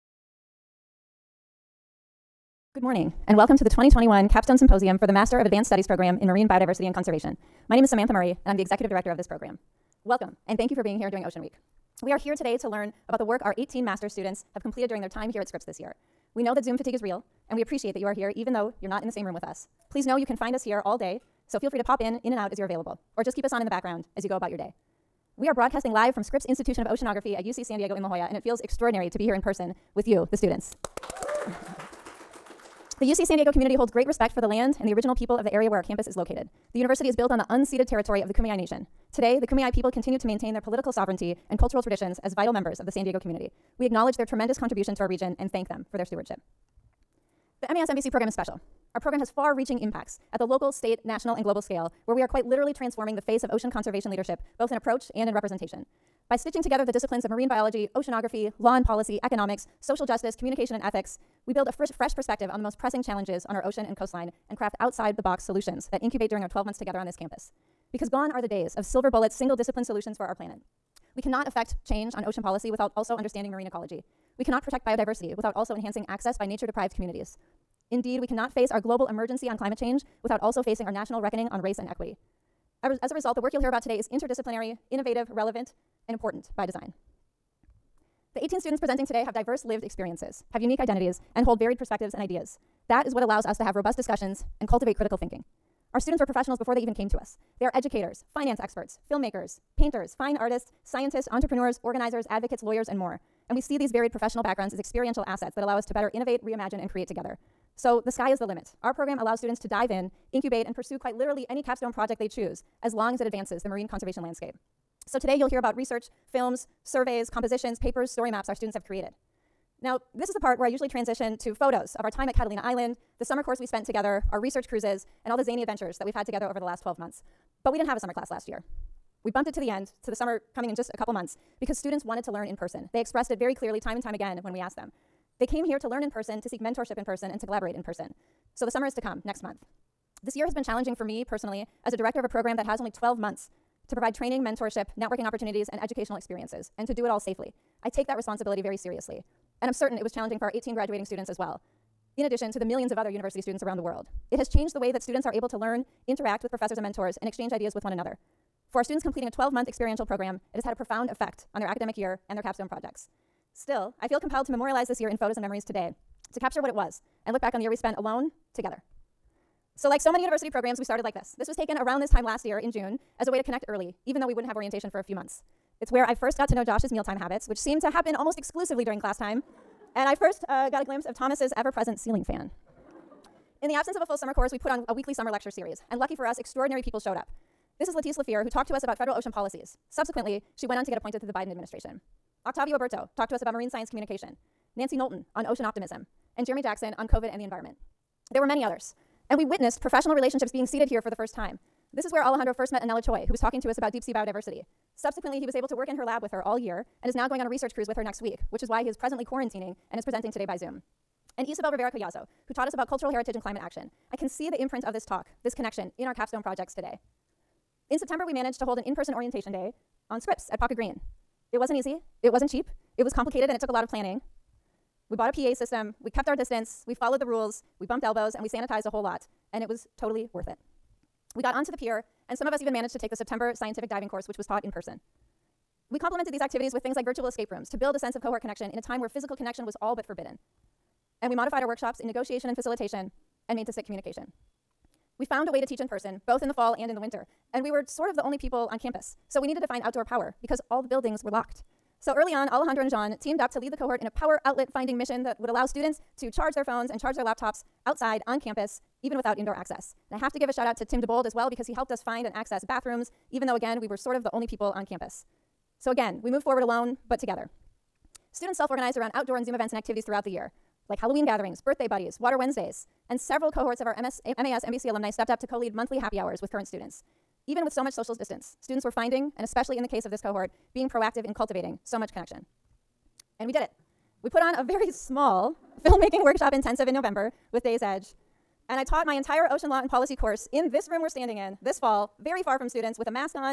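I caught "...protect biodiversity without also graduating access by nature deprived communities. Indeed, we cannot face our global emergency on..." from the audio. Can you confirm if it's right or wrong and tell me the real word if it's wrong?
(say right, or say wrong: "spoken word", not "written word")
wrong: "enhancing", not "graduating".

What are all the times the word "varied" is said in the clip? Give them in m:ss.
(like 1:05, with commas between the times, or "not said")
1:31, 1:43.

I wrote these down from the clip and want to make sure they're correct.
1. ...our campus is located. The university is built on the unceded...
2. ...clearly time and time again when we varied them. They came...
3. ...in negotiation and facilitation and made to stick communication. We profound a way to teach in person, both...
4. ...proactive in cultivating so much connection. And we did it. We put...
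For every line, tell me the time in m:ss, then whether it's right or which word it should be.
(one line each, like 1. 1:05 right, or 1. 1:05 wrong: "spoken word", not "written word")
1. 0:35 right
2. 2:13 wrong: "asked", not "varied"
3. 4:01 wrong: "found", not "profound"
4. 4:40 right.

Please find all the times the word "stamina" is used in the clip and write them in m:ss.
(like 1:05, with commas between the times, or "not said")
not said.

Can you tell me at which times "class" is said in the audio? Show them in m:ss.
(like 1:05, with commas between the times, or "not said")
2:08, 2:59.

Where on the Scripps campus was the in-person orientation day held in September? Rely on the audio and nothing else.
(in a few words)
Pawka Green.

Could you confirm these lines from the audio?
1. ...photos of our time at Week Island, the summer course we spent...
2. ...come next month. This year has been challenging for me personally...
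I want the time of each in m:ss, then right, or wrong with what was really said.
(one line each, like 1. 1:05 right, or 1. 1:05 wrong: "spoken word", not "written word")
1. 2:01 wrong: "Catalina", not "Week"
2. 2:18 right.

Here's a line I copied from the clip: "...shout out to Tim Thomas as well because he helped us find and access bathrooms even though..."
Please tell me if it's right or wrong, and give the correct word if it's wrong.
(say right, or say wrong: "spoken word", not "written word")
wrong: "DeBold", not "Thomas".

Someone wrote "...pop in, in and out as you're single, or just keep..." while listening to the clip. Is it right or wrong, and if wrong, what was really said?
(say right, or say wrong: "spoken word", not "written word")
wrong: "available", not "single".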